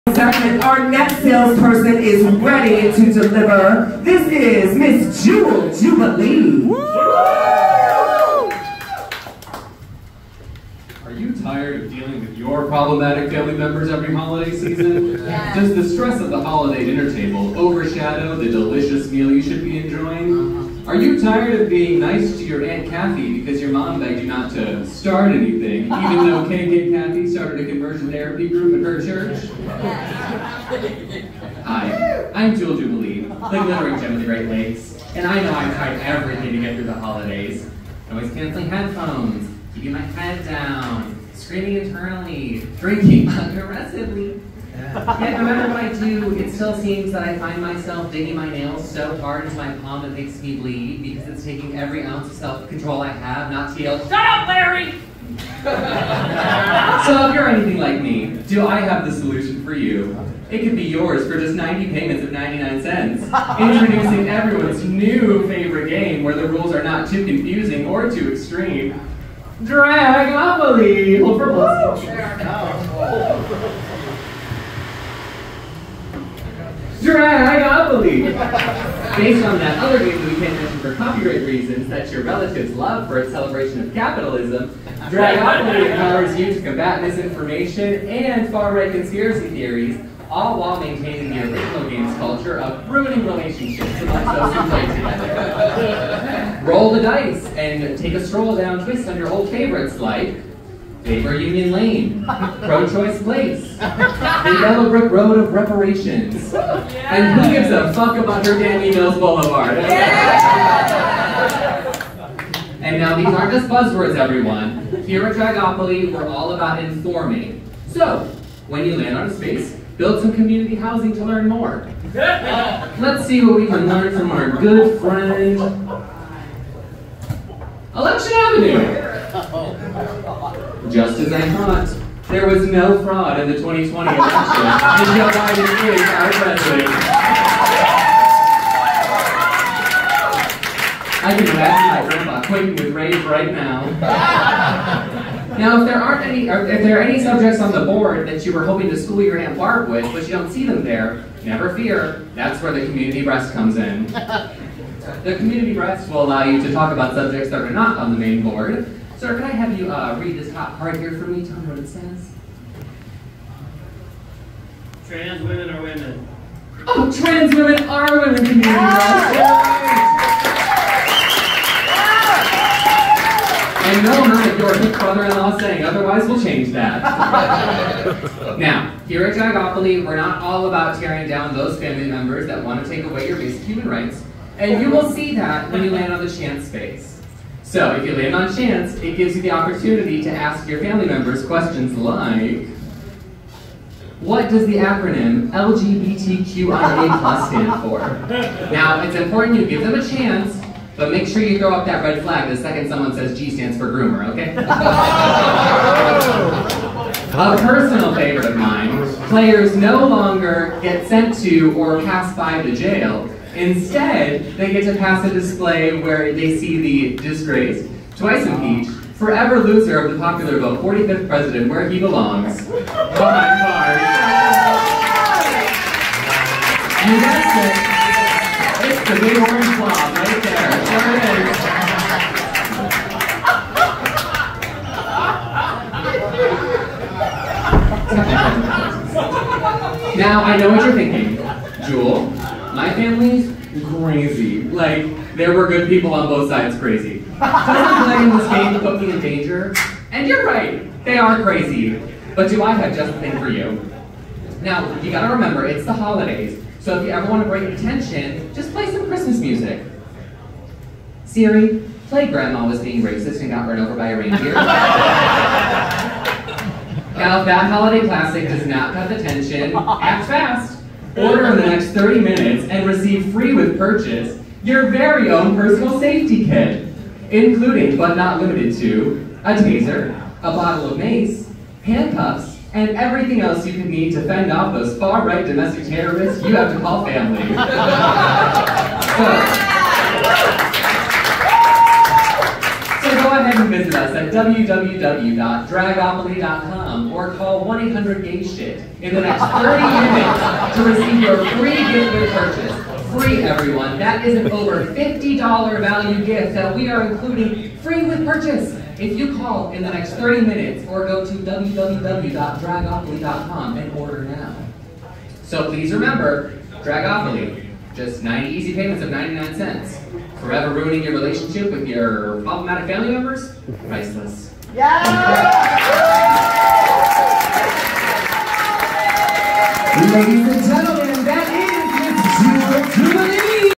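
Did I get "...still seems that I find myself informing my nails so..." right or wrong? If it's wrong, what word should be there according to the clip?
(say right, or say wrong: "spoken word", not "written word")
wrong: "digging", not "informing".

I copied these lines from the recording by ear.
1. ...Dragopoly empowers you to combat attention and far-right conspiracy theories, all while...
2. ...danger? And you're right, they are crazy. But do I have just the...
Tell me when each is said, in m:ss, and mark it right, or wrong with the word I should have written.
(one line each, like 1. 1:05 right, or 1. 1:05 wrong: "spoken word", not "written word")
1. 1:25 wrong: "misinformation", not "attention"
2. 4:09 right.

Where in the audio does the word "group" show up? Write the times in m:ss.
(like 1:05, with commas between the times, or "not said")
0:28.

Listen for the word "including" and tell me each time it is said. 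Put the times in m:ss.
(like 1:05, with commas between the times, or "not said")
4:37, 5:07.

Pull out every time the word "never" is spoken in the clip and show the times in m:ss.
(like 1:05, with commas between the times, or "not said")
2:31.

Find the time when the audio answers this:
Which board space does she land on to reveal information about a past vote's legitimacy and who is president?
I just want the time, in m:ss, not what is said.
2:07.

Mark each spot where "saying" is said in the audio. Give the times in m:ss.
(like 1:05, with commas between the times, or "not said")
2:55.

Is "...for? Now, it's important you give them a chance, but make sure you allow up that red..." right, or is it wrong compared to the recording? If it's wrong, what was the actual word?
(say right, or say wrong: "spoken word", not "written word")
wrong: "throw", not "allow".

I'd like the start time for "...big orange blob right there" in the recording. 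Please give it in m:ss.
3:49.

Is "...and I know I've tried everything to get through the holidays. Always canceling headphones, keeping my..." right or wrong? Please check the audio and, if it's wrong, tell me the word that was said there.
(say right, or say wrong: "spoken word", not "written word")
right.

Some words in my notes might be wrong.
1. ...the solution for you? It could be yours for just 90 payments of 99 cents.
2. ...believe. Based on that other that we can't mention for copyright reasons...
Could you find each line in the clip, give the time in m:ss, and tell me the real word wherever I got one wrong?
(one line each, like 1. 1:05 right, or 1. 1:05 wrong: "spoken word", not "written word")
1. 0:59 right
2. 1:17 right.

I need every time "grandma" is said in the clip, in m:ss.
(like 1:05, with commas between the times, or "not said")
2:22, 4:22.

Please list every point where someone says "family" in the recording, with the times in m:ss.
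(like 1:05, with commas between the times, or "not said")
0:13, 3:01, 3:10, 4:02, 4:47, 5:22.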